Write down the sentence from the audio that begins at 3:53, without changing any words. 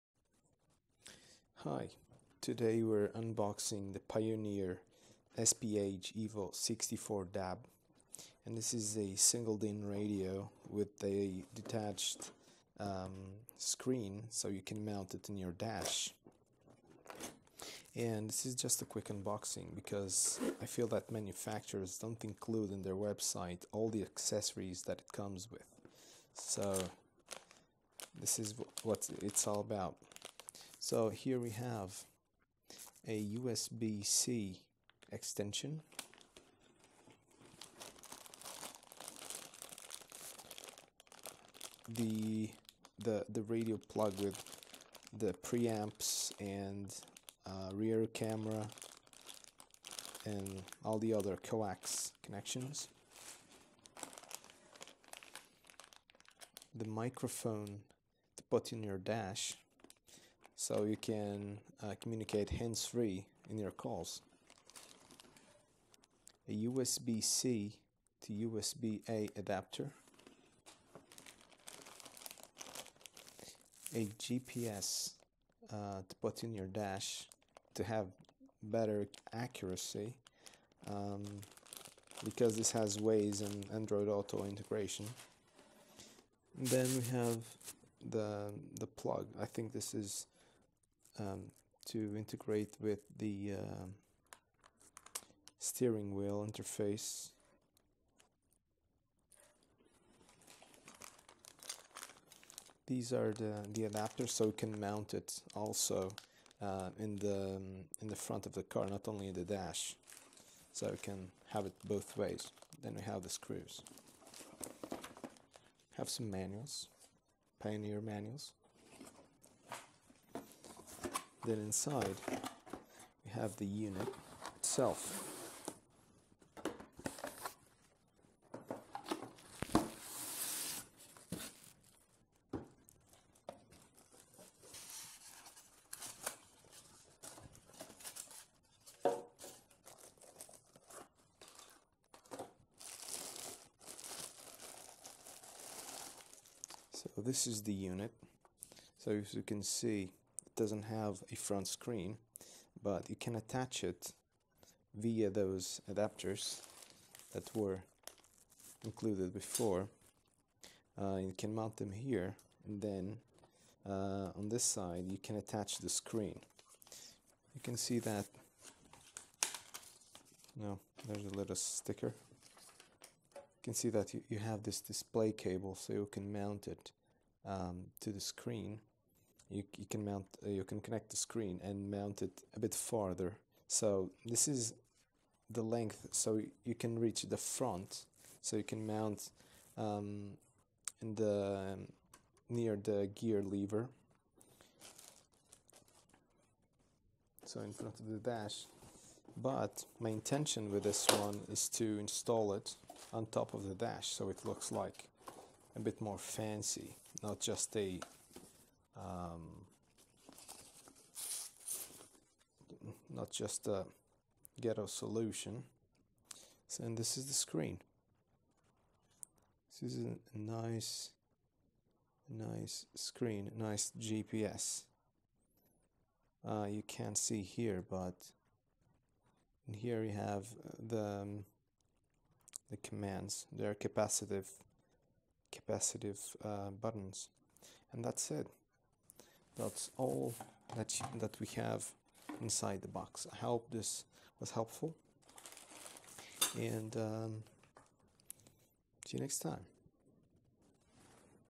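They're capacitive, capacitive uh, buttons, and that's it.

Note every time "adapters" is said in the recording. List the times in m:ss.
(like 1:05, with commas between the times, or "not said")
1:09, 1:43, 2:35.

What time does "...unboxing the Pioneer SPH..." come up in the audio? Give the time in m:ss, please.
0:03.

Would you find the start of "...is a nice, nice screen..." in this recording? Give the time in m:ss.
3:39.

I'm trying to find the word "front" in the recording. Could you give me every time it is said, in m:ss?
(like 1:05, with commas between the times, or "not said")
1:48, 2:31, 3:07, 3:17.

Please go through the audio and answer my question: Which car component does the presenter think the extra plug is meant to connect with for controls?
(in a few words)
Steering wheel interface.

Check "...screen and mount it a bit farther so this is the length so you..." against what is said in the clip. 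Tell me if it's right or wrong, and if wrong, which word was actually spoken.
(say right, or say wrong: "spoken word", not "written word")
right.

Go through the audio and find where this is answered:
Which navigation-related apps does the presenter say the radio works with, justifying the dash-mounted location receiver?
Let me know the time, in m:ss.
1:22.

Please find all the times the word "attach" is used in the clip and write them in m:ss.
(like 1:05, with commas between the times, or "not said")
2:33, 2:45.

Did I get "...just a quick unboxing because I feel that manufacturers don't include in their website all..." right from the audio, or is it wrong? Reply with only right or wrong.
right.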